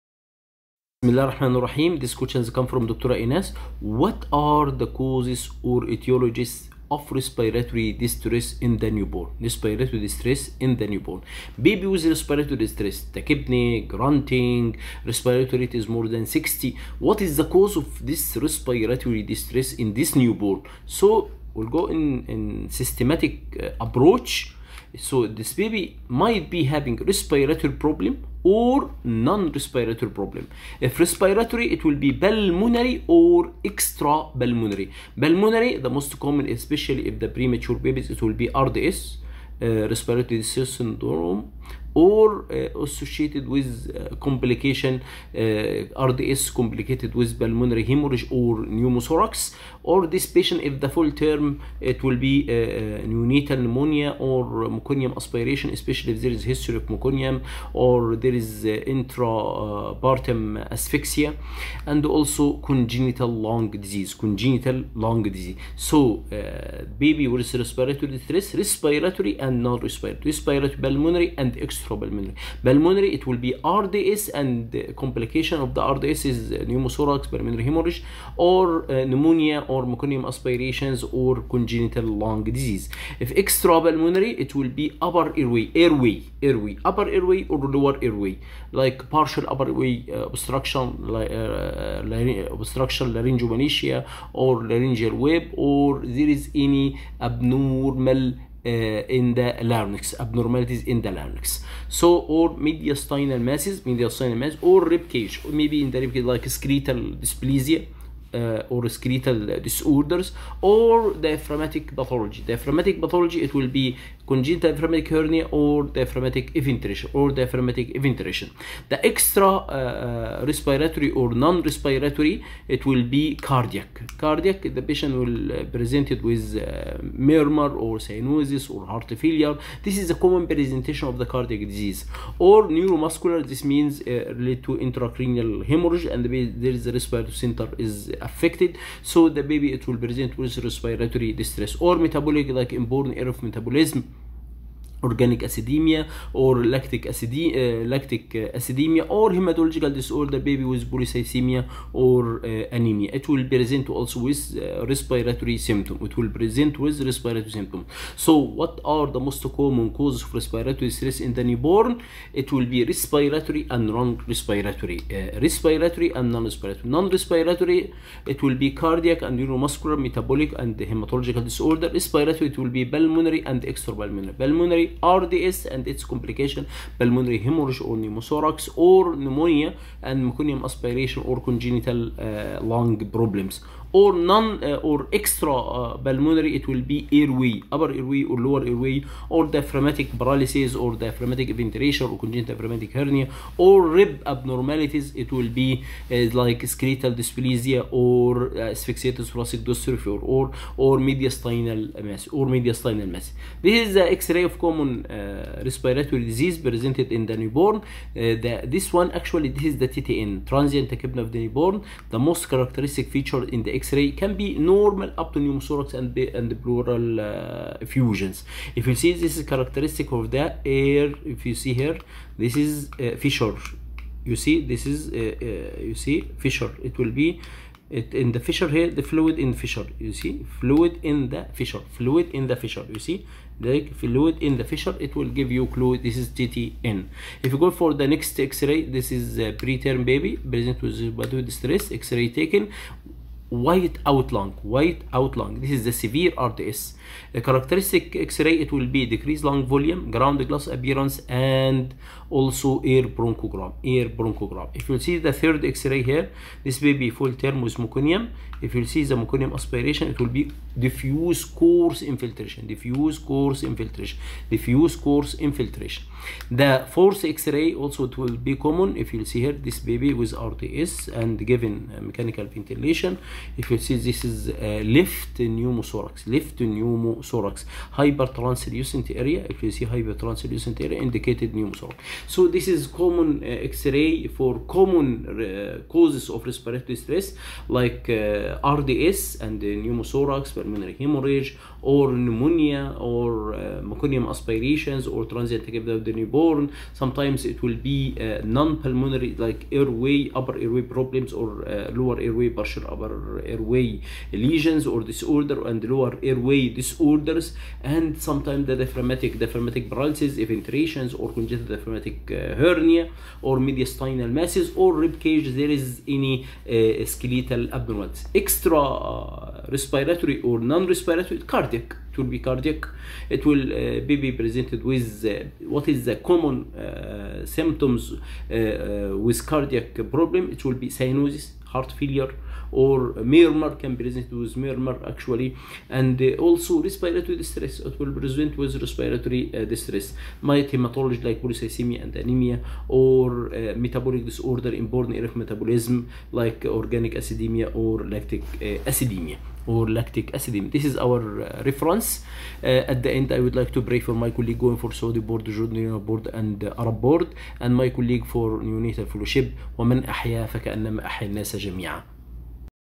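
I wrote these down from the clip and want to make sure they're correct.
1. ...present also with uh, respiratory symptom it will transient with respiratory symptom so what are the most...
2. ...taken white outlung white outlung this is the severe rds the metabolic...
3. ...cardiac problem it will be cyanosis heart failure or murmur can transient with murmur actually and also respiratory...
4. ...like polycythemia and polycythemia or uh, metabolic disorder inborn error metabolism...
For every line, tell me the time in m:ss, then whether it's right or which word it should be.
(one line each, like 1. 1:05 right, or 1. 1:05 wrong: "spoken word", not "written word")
1. 2:33 wrong: "present", not "transient"
2. 4:02 wrong: "characteristic", not "metabolic"
3. 5:29 wrong: "present", not "transient"
4. 5:41 wrong: "anemia", not "polycythemia".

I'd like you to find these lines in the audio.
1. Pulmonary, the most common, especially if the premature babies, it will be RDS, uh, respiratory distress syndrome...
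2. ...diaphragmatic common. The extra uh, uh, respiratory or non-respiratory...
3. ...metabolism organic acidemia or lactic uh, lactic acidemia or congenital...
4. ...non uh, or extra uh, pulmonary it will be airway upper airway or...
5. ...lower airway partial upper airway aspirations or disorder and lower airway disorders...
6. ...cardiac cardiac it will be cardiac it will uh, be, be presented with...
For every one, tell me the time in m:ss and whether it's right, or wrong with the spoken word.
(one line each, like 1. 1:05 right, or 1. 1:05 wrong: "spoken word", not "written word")
1. 0:35 right
2. 1:57 wrong: "eventuation", not "common"
3. 2:23 wrong: "hematological", not "congenital"
4. 3:04 right
5. 5:01 wrong: "lesions", not "aspirations"
6. 5:21 right.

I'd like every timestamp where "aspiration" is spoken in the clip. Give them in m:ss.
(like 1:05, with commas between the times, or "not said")
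0:55, 1:20, 3:00, 4:19, 4:54.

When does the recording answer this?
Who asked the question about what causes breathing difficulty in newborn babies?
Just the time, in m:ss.
0:02.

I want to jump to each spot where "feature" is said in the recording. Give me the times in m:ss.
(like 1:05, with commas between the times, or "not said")
3:33.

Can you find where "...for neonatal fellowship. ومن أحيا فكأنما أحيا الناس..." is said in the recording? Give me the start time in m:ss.
5:58.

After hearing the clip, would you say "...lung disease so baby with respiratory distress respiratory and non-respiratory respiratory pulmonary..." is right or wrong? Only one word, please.
right.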